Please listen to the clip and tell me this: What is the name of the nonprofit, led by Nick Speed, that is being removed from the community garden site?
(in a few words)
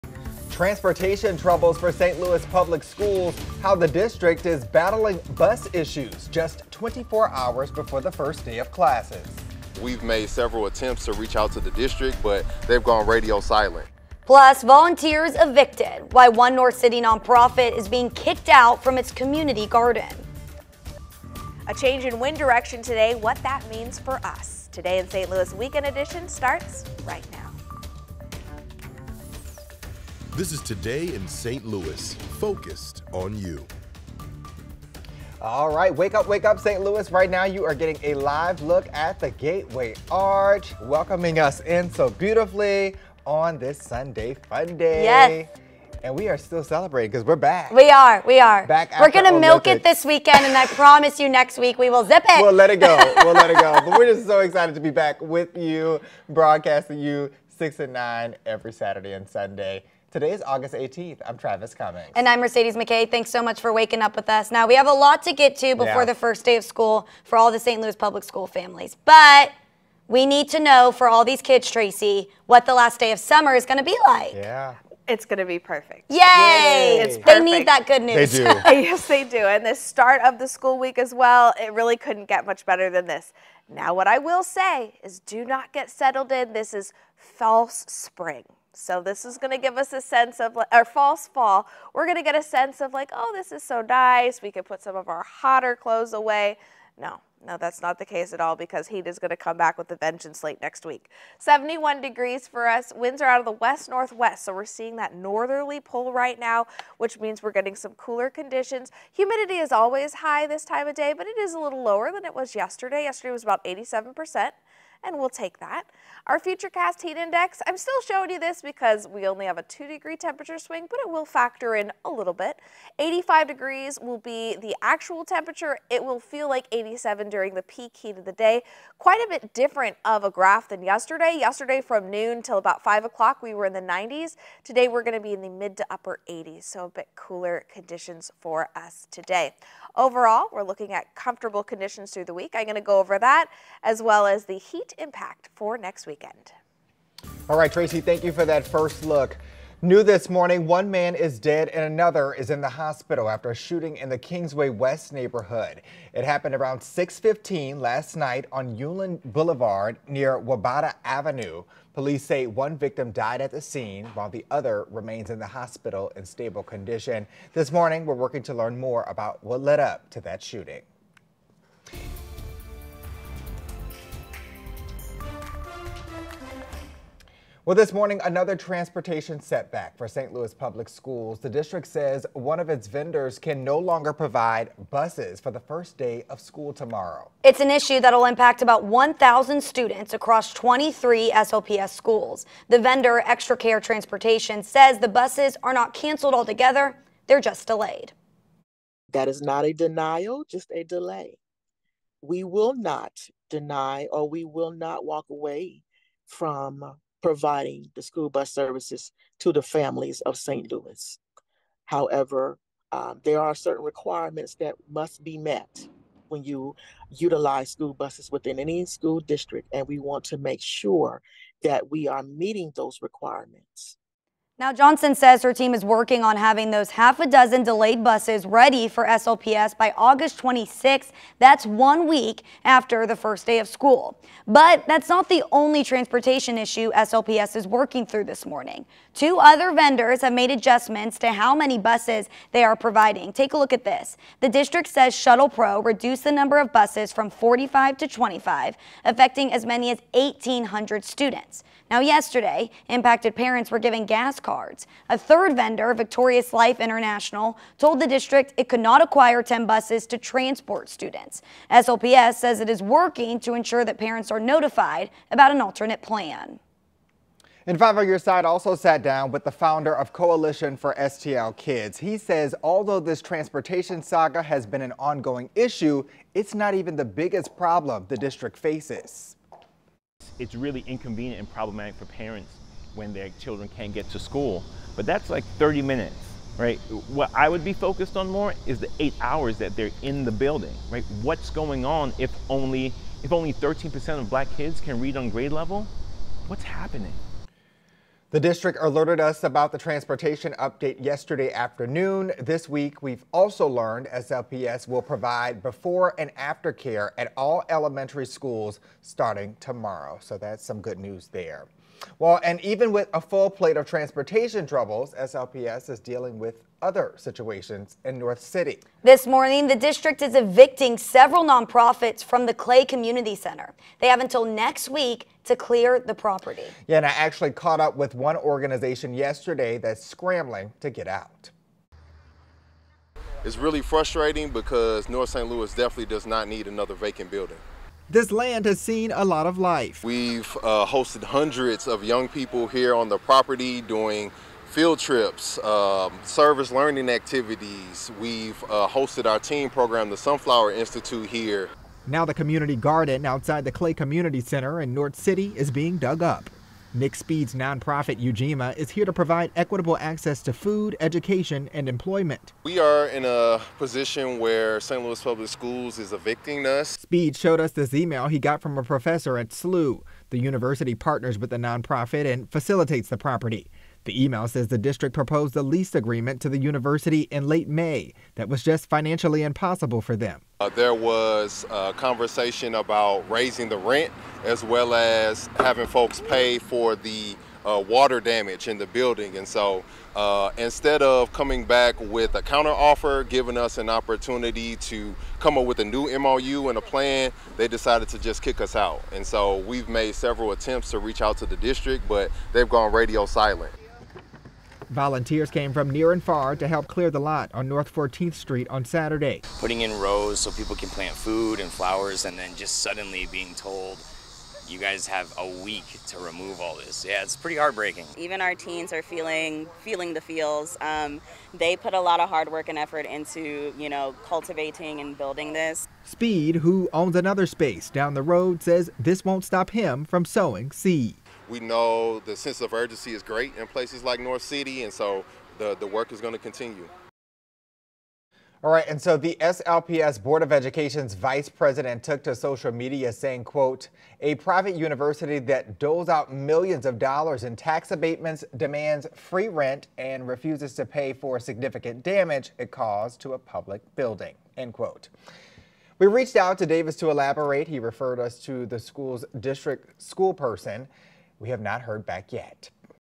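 Ujima.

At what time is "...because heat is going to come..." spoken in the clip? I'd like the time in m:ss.
1:38.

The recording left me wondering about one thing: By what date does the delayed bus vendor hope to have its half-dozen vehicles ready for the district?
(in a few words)
August 26th.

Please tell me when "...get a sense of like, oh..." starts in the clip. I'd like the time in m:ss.
1:32.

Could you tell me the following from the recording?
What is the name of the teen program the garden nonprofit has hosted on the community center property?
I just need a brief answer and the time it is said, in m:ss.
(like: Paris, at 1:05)
Sunflower Institute, at 5:50.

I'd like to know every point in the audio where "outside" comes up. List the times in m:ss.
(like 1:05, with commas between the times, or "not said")
5:53.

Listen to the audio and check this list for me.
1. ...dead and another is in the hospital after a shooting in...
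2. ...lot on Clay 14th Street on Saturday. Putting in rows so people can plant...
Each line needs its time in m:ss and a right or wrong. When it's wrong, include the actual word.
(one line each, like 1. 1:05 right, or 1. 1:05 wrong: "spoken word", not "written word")
1. 2:31 right
2. 6:47 wrong: "North", not "Clay".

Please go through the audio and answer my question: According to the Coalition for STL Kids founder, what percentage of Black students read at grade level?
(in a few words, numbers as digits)
13%.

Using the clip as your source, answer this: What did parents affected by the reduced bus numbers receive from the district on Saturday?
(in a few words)
Gas cards.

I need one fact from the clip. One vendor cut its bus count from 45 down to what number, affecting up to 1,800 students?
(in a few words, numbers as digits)
25.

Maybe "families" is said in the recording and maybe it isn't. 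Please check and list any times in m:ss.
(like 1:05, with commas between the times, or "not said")
1:08, 3:29.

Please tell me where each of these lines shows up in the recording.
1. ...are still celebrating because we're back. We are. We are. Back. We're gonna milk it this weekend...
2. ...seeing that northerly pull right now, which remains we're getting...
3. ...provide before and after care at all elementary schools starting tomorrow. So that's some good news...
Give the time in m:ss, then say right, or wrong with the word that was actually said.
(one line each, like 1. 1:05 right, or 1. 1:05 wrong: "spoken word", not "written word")
1. 0:46 right
2. 1:44 wrong: "means", not "remains"
3. 5:05 right.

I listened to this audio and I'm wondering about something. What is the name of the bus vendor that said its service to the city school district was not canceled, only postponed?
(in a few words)
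Extra Care Transportation.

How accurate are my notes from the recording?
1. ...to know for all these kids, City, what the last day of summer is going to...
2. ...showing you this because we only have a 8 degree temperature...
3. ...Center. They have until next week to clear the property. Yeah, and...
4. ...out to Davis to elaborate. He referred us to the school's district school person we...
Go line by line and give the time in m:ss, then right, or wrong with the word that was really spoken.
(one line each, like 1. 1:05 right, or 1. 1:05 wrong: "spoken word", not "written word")
1. 1:10 wrong: "Tracy", not "City"
2. 1:58 wrong: "2", not "8"
3. 5:23 right
4. 7:36 right.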